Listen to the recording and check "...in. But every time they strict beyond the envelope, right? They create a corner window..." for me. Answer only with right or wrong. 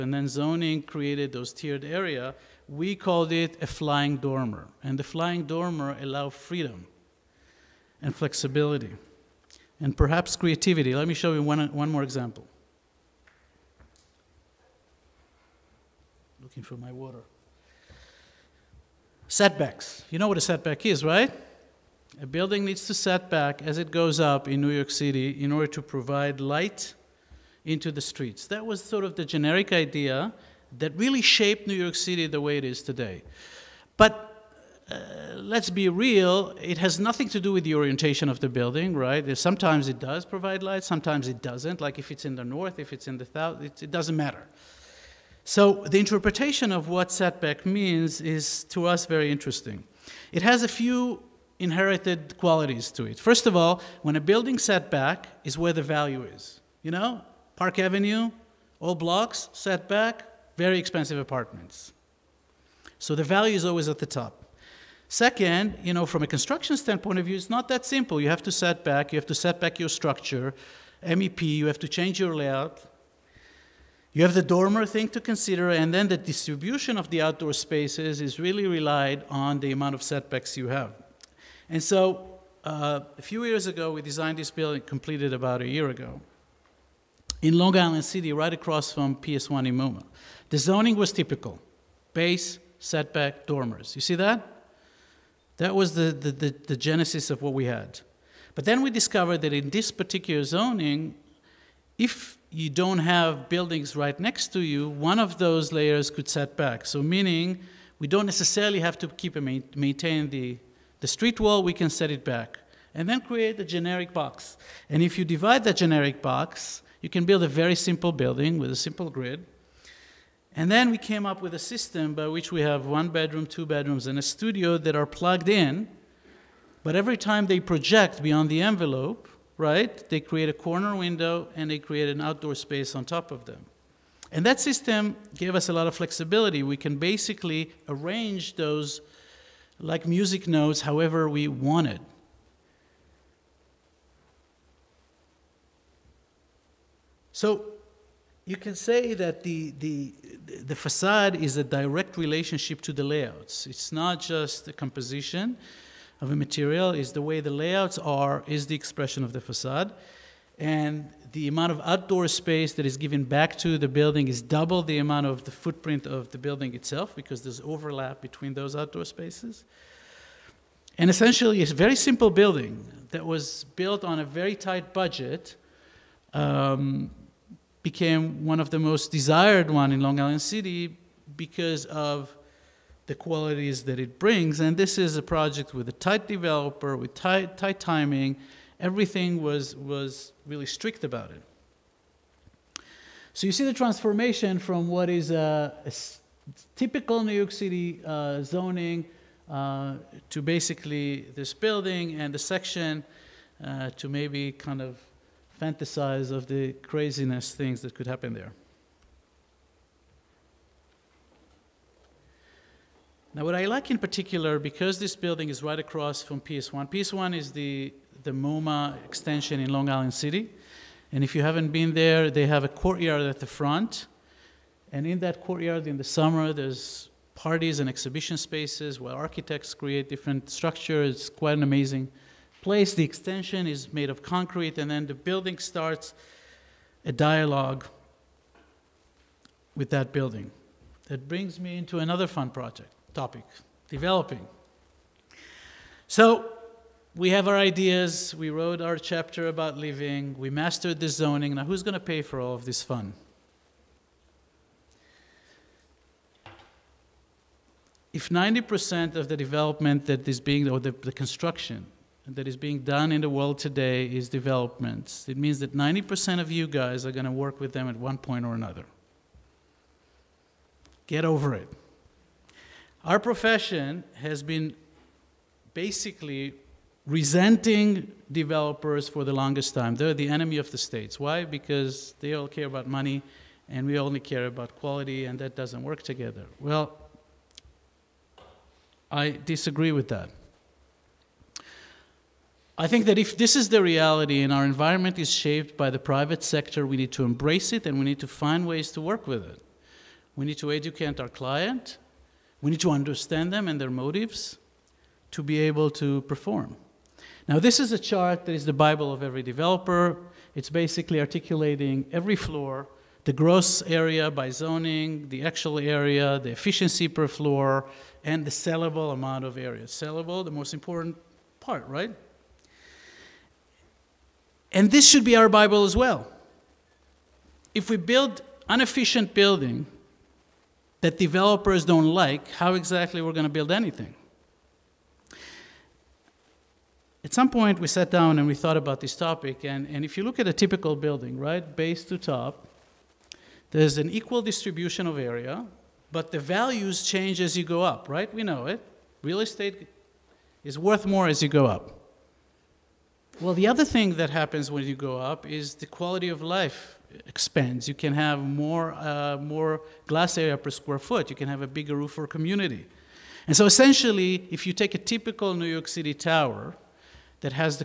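wrong.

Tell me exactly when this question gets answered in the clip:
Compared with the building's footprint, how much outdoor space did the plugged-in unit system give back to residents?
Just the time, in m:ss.
2:44.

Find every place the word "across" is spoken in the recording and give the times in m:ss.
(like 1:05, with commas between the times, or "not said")
1:28, 3:35.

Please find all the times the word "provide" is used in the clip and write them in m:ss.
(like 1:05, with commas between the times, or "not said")
0:25, 0:40.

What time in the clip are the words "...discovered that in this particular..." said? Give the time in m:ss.
1:38.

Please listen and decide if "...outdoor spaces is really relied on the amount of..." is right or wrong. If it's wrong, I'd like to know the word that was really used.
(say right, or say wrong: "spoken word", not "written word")
right.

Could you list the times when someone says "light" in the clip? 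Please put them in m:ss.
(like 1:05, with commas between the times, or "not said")
0:26, 0:40.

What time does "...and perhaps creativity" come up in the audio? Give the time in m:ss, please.
0:09.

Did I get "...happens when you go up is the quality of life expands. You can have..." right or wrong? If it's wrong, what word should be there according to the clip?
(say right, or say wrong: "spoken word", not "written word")
right.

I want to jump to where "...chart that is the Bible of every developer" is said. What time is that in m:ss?
5:07.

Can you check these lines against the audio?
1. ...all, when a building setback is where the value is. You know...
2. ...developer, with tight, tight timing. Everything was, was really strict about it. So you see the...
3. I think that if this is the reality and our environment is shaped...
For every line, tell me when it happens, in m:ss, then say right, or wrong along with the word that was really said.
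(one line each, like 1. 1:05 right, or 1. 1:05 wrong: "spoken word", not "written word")
1. 0:53 right
2. 3:06 right
3. 4:52 right.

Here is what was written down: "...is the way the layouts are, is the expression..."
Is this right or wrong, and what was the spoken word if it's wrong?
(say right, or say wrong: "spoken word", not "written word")
right.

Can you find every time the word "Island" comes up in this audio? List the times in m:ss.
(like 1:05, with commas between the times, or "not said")
1:27, 3:00, 3:39.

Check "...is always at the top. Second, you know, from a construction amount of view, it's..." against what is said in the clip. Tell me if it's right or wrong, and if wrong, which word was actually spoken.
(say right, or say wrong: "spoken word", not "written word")
wrong: "standpoint", not "amount".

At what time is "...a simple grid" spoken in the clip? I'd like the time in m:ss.
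1:58.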